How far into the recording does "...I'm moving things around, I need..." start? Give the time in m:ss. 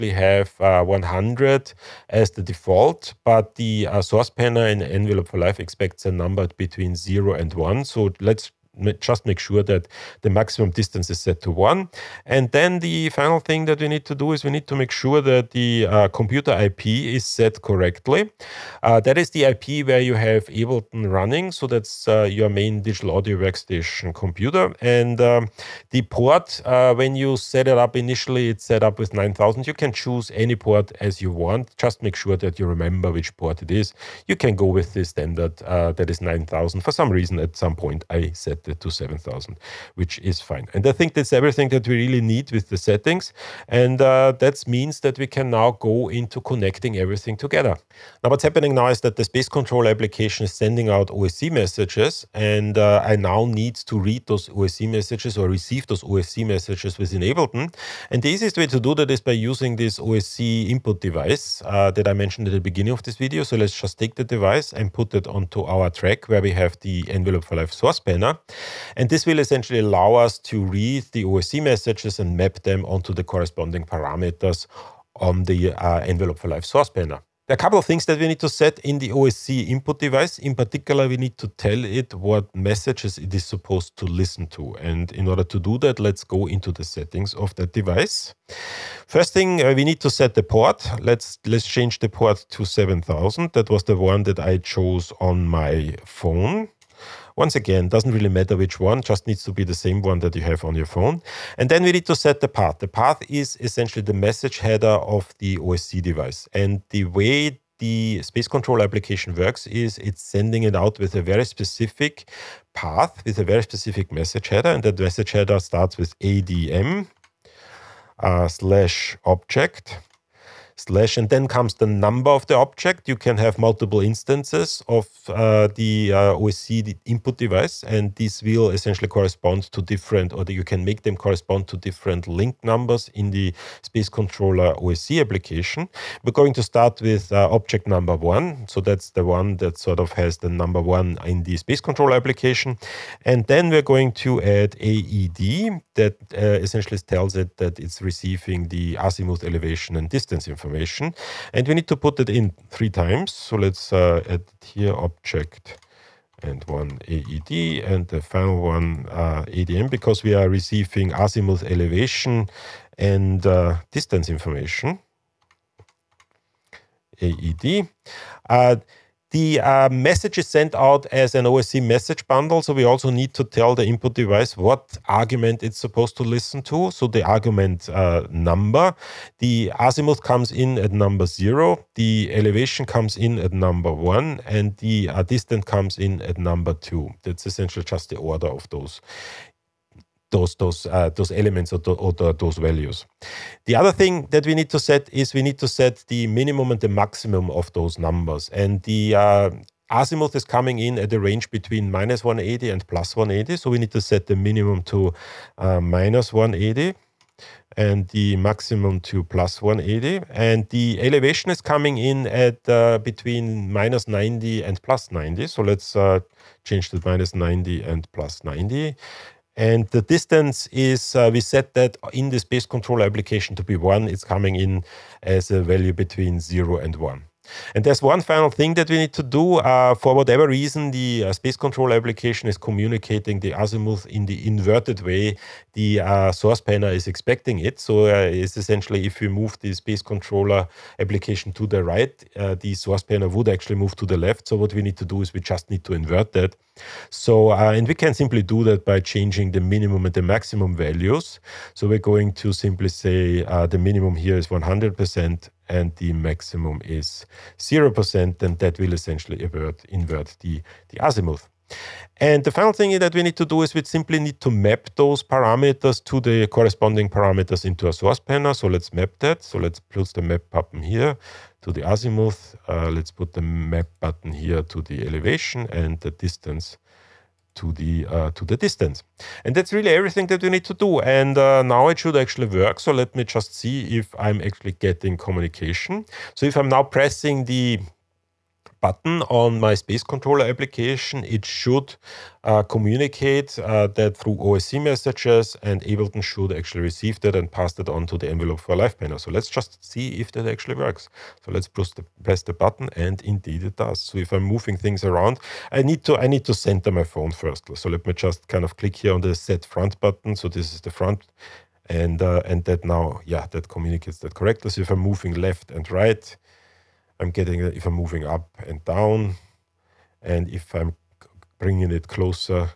5:04.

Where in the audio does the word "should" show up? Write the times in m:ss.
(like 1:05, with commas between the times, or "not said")
4:41, 4:51, 4:56.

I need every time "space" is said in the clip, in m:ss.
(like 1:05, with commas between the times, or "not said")
0:49, 1:48, 2:13, 2:21, 3:42, 3:51, 3:59, 4:49.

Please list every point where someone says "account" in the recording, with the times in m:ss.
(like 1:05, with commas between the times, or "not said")
not said.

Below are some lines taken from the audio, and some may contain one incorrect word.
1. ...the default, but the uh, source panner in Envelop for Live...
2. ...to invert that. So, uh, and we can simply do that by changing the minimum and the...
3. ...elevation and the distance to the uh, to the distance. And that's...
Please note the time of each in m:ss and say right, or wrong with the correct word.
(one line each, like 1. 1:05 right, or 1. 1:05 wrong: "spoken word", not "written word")
1. 0:02 right
2. 4:05 right
3. 4:35 right.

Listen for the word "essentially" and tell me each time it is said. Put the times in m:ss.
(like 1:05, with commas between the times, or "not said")
1:09, 1:43, 2:08, 2:26, 3:07, 3:58, 4:18.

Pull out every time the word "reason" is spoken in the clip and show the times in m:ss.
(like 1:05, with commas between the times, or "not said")
0:37, 3:50.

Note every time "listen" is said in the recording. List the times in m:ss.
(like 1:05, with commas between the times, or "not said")
1:24, 2:56.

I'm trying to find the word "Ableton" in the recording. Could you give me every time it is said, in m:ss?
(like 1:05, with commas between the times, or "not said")
0:20, 0:57, 4:55.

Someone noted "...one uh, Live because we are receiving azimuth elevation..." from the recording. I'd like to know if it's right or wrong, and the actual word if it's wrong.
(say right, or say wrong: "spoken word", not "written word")
wrong: "ADM", not "Live".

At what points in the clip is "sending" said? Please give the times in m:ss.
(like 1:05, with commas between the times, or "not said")
0:50, 1:50.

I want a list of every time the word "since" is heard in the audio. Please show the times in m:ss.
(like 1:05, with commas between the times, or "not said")
not said.